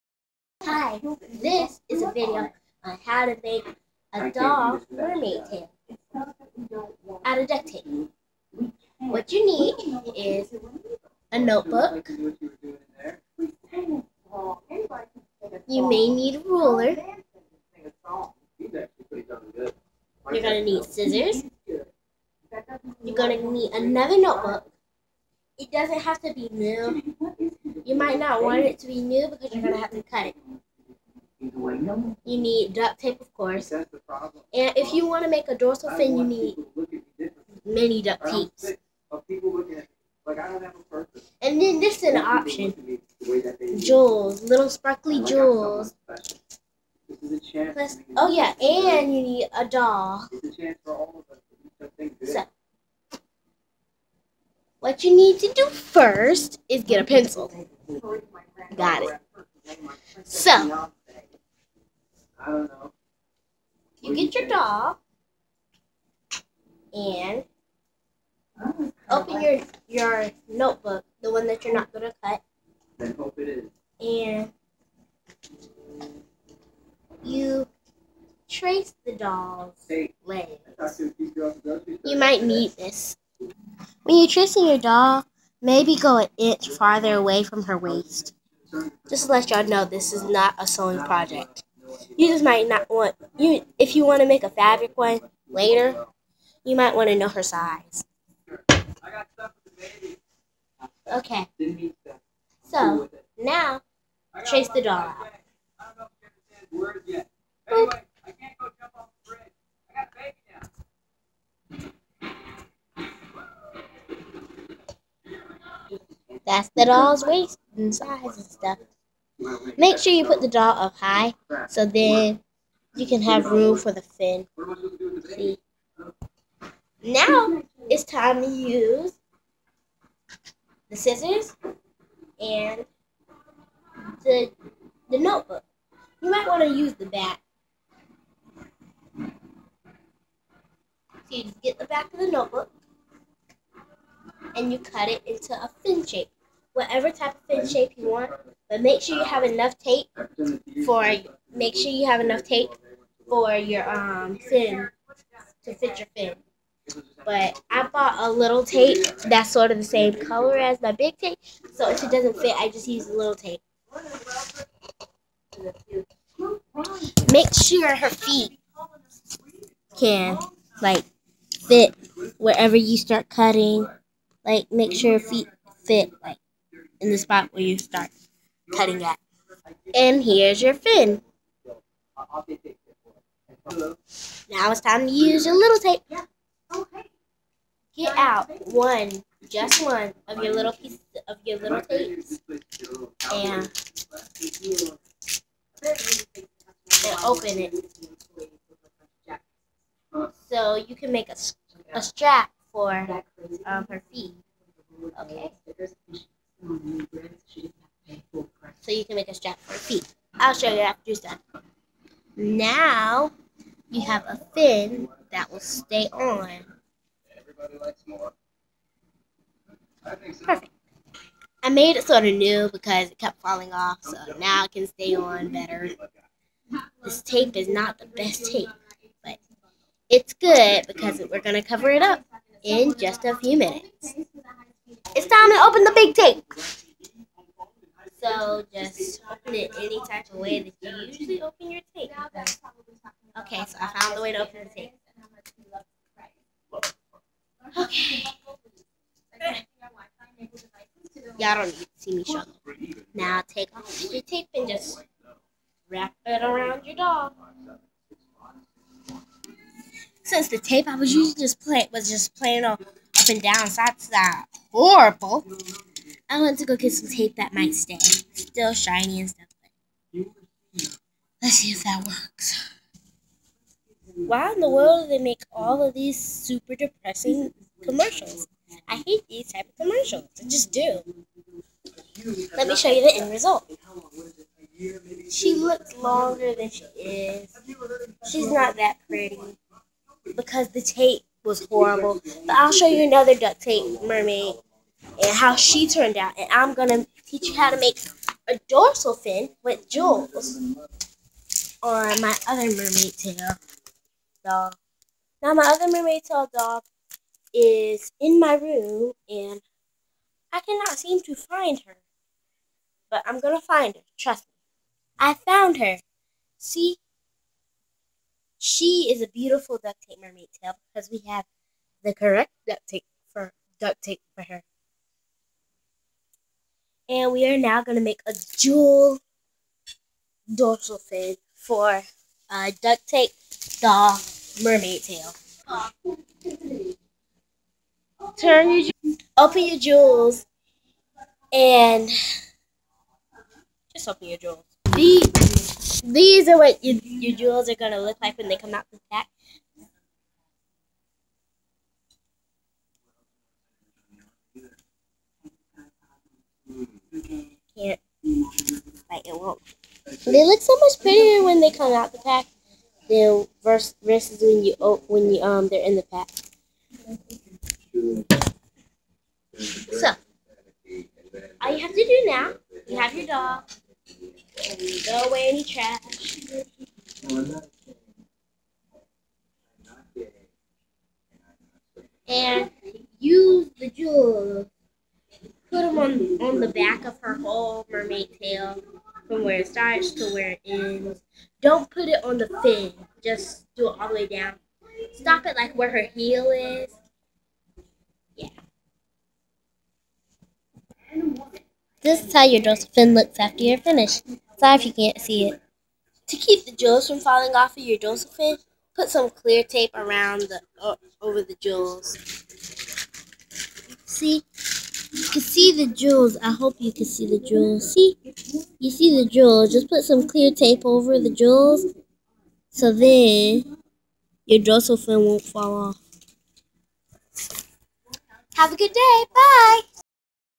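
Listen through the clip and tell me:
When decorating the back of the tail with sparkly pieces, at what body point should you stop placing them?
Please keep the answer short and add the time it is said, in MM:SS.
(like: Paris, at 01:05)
her heel, at 06:35.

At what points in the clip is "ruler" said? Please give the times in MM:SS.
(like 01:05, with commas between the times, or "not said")
00:16.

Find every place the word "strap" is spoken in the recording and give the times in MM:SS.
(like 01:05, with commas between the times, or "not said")
03:22, 03:29.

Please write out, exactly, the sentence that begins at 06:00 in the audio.
They look so much prettier when they come out the pack than versus when you when you um they're in the pack.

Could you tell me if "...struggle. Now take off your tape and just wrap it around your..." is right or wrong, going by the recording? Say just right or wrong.
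right.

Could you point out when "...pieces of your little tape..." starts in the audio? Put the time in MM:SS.
03:10.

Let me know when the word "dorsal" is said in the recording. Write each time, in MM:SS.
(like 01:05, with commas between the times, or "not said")
00:35, 04:58, 05:30, 06:42, 06:47, 07:04.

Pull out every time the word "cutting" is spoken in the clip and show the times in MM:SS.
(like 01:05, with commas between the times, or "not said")
02:53, 02:58.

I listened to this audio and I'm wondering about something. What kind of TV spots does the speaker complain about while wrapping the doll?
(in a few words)
super depressing commercials.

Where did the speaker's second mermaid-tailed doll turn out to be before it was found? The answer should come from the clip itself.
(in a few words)
in my room.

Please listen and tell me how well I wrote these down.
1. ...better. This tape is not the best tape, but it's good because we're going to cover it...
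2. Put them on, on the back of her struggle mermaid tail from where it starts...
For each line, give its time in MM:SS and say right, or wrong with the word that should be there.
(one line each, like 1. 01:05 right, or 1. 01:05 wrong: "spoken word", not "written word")
1. 03:45 right
2. 06:25 wrong: "whole", not "struggle".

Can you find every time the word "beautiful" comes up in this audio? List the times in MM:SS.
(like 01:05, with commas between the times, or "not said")
05:19.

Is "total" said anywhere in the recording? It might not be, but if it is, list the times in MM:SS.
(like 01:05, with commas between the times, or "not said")
not said.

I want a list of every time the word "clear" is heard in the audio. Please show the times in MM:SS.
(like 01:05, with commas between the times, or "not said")
06:49, 07:00.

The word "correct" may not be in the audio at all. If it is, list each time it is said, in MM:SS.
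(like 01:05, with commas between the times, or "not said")
05:22.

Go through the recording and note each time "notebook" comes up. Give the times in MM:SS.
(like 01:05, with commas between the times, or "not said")
00:11, 00:24, 01:10, 02:15, 02:22.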